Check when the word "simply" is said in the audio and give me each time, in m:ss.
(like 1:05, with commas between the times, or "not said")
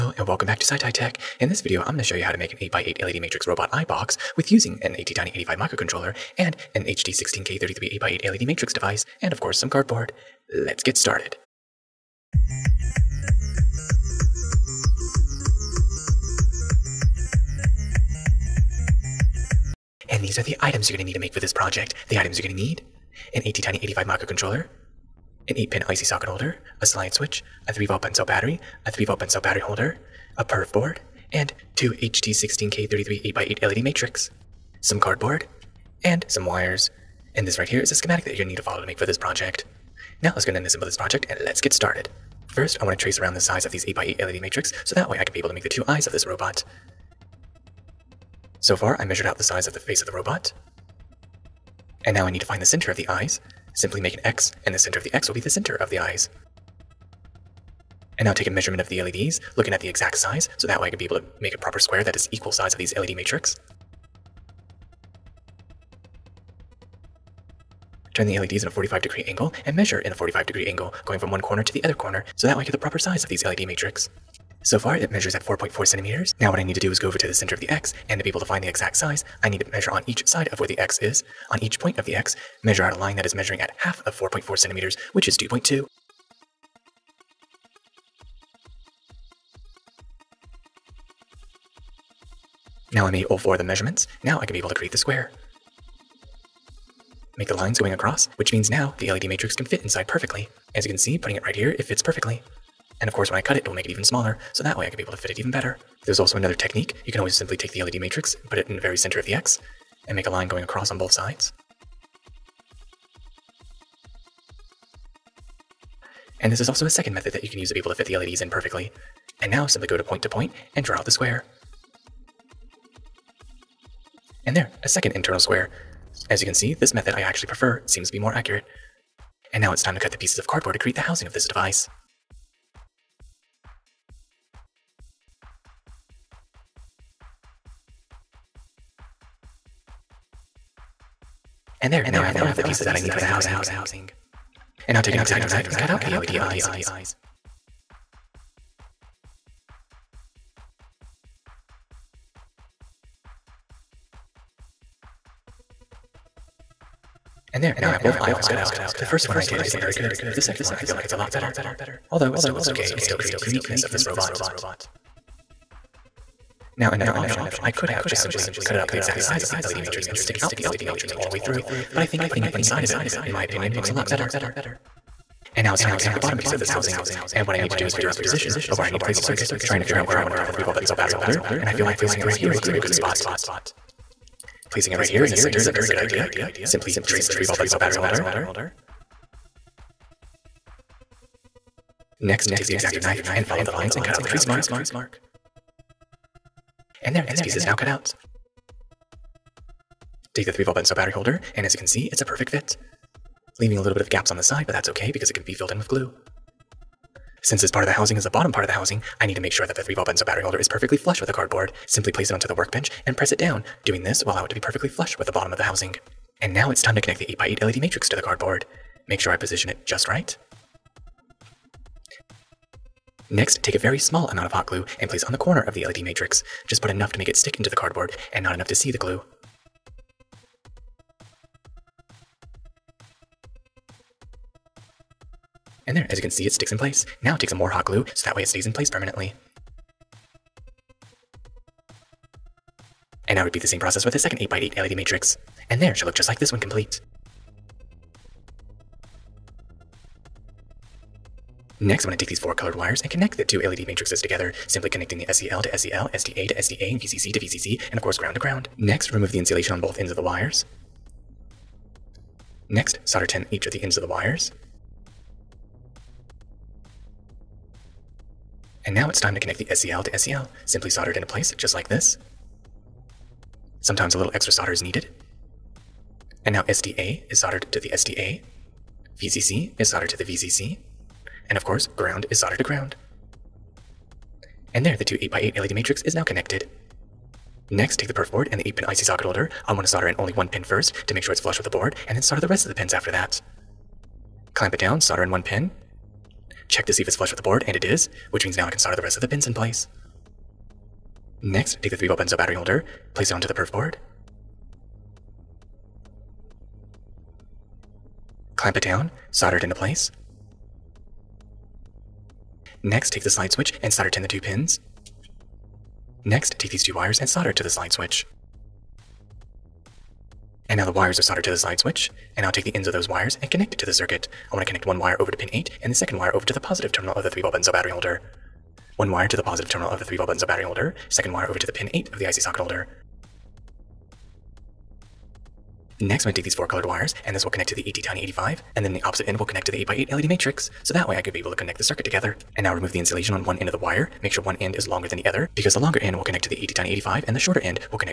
0:53, 1:47, 1:59, 2:48, 3:06, 3:31, 4:14, 4:30.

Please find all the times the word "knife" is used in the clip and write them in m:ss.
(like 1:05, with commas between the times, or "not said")
2:25, 3:13.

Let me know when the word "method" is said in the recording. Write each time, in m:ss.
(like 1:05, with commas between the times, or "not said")
1:57, 2:06.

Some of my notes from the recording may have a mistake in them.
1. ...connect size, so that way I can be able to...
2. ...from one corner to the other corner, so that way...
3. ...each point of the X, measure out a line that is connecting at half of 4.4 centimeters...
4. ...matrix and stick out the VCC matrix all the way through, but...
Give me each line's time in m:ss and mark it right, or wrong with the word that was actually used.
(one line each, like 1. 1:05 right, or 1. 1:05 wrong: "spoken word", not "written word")
1. 0:59 wrong: "exact", not "connect"
2. 1:11 right
3. 1:21 wrong: "measuring", not "connecting"
4. 2:49 wrong: "LED", not "VCC".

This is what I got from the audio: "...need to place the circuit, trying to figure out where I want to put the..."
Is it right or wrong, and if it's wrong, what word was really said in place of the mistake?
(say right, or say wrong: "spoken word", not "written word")
right.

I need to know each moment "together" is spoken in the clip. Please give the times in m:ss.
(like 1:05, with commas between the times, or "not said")
4:14, 5:42.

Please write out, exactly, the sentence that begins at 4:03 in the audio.
And now repeat the same process with the second 8x8 LED matrix.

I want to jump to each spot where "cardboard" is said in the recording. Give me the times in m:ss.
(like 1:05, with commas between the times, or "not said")
0:09, 0:34, 2:10, 3:31, 3:38, 3:47.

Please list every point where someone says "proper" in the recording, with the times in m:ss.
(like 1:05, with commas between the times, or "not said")
1:01, 1:12.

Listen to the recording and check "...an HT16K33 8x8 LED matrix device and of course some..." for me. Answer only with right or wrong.
right.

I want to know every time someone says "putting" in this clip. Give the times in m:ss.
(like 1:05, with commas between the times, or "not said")
1:41, 2:52.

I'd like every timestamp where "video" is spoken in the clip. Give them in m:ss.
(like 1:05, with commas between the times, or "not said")
0:01.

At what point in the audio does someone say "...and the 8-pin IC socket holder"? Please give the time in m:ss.
4:48.